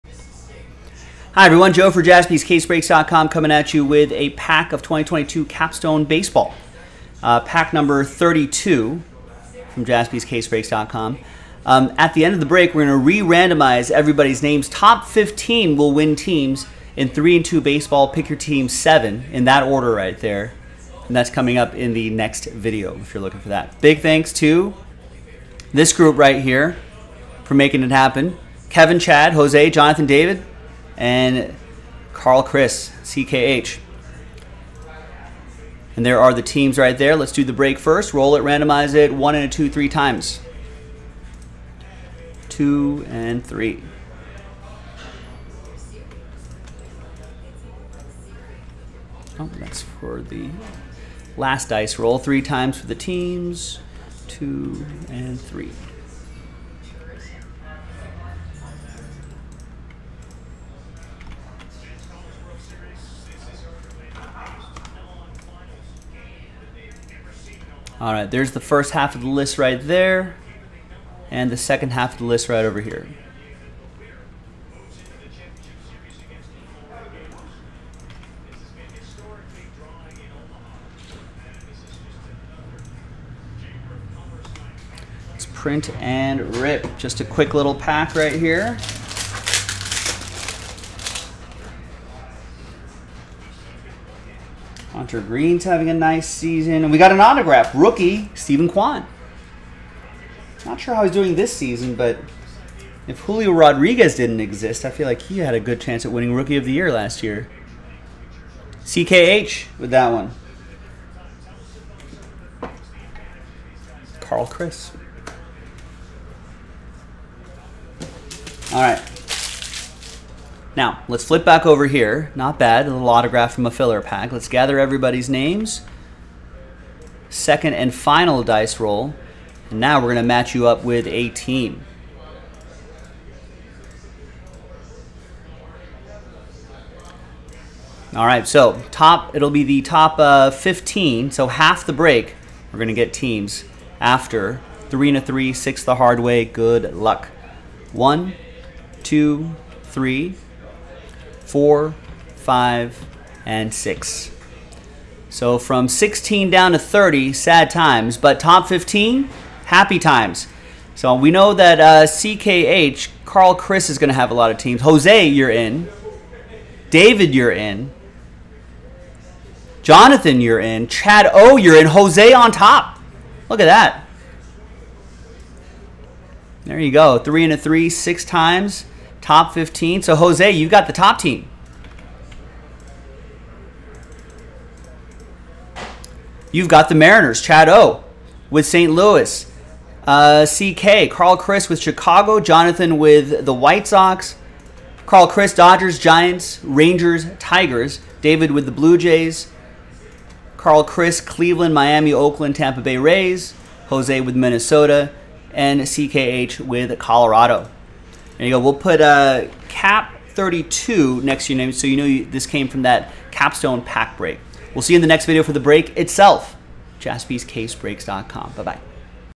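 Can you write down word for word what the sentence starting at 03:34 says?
We'll see you in the next video for the break itself.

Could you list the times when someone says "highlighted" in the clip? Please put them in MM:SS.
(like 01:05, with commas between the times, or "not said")
not said.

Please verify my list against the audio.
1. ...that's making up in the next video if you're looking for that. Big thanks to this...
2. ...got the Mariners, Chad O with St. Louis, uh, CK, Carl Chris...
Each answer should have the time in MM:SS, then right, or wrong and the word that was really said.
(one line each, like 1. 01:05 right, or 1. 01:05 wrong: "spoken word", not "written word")
1. 00:21 wrong: "coming", not "making"
2. 03:06 right.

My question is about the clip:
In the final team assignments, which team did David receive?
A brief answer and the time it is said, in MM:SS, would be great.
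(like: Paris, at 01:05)
Blue Jays, at 03:18.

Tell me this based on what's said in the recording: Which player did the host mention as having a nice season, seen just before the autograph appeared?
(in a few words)
Hunter Greene.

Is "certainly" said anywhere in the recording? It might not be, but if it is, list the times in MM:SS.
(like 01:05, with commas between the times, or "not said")
not said.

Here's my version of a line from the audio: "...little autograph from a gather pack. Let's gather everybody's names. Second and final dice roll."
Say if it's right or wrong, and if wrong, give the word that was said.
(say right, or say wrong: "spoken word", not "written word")
wrong: "filler", not "gather".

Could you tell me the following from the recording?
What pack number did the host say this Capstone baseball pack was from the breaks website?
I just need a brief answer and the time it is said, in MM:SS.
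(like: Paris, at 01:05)
32, at 00:07.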